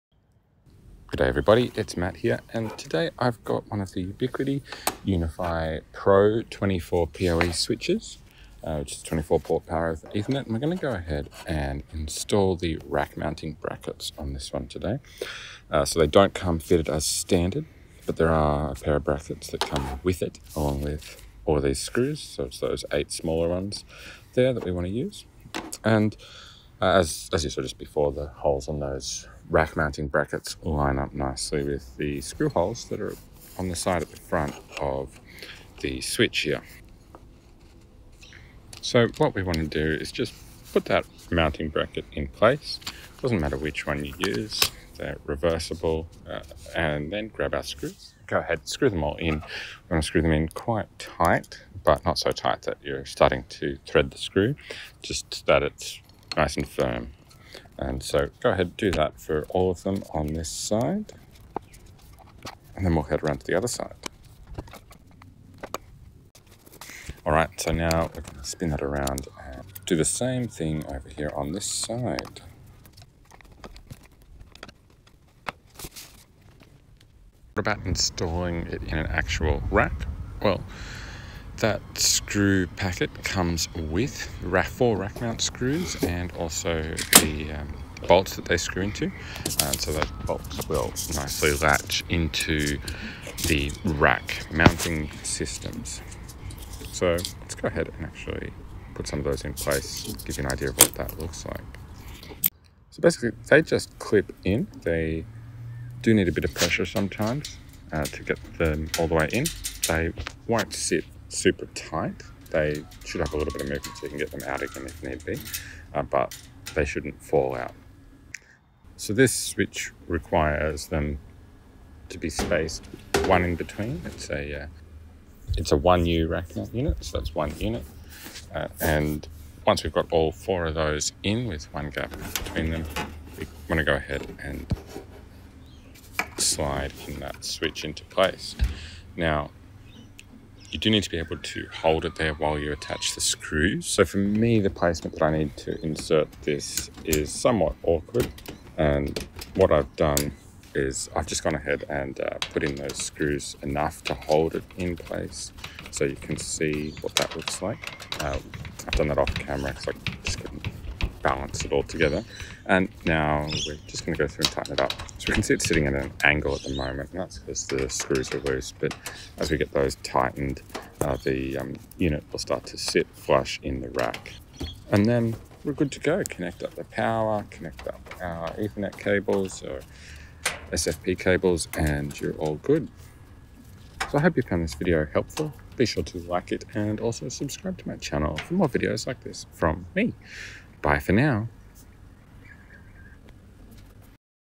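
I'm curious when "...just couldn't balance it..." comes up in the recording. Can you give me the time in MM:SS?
02:40.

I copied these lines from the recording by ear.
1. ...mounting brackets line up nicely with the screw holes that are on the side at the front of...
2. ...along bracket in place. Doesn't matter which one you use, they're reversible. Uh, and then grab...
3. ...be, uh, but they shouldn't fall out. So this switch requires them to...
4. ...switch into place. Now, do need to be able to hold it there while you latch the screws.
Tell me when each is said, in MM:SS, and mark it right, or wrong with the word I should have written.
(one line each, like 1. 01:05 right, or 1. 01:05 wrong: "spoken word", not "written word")
1. 00:29 right
2. 00:41 wrong: "mounting", not "along"
3. 01:55 right
4. 02:17 wrong: "attach", not "latch".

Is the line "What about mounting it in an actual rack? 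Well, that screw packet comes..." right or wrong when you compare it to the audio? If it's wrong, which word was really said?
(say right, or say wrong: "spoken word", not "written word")
wrong: "installing", not "mounting".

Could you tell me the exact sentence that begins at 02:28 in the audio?
And what I've done is I've just gone ahead and uh, put in those screws enough to hold it in place.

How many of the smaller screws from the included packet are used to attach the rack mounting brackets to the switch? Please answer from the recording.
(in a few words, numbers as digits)
8.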